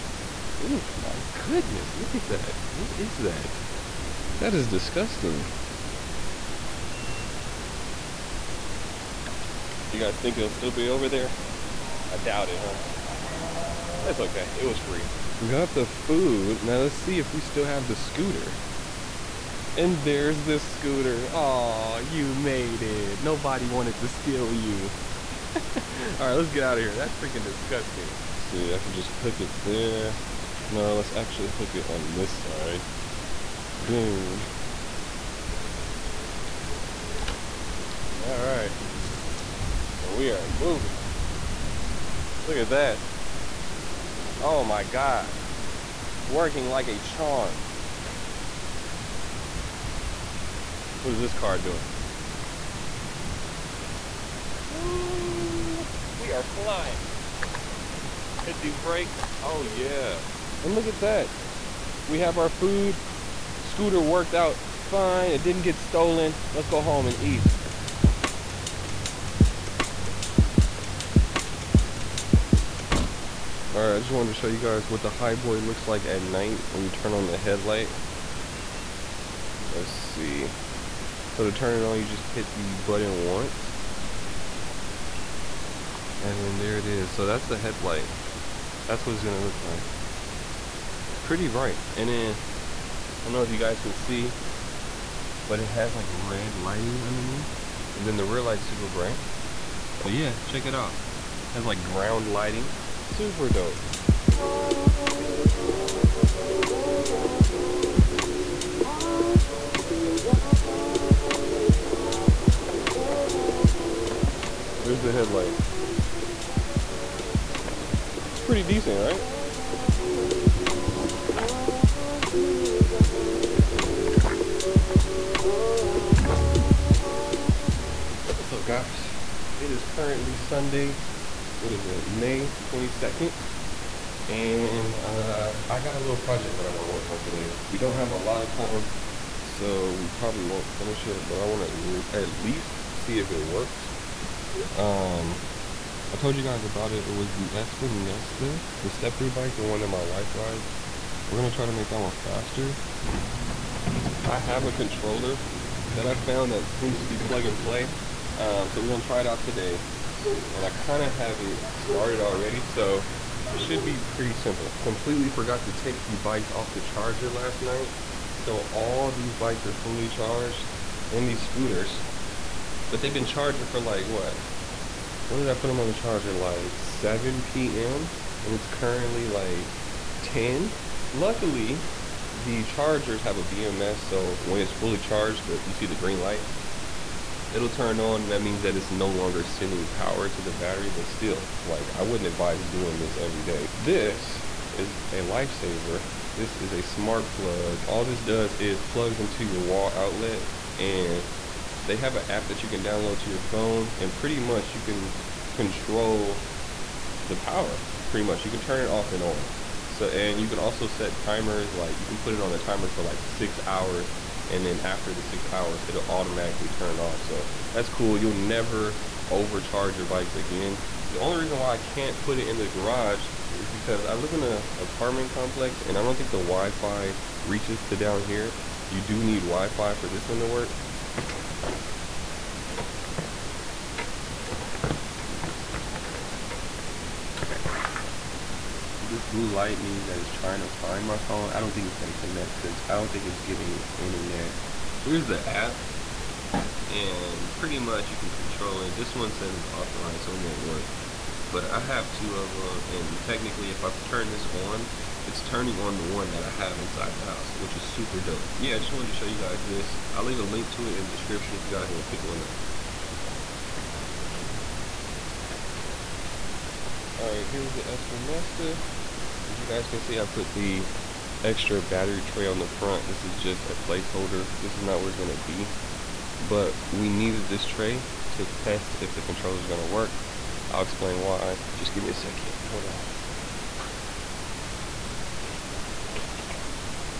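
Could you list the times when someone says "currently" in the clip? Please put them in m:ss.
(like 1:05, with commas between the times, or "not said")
2:09, 2:58.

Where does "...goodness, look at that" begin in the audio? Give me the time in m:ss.
0:01.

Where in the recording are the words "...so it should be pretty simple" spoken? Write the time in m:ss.
2:42.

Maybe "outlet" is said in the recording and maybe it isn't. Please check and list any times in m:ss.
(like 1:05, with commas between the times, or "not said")
3:19.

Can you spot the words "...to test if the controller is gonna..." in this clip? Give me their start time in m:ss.
4:38.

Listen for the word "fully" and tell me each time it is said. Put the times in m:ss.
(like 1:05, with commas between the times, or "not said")
2:49, 3:04.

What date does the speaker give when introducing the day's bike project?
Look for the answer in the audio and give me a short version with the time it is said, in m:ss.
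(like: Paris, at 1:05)
May 22nd, at 2:12.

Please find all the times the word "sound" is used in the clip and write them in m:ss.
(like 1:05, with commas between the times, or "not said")
not said.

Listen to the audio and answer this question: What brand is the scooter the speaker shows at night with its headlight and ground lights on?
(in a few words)
Hiboy.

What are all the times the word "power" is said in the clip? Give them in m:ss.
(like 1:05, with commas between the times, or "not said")
3:09, 3:27.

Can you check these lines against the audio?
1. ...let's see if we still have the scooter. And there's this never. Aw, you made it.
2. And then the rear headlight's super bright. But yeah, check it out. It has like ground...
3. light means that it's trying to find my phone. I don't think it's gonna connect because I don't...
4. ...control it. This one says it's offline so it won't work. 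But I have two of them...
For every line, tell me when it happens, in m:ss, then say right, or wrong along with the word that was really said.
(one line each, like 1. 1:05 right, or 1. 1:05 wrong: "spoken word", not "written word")
1. 0:16 wrong: "scooter", not "never"
2. 1:37 wrong: "light", not "headlight"
3. 3:59 right
4. 4:08 right.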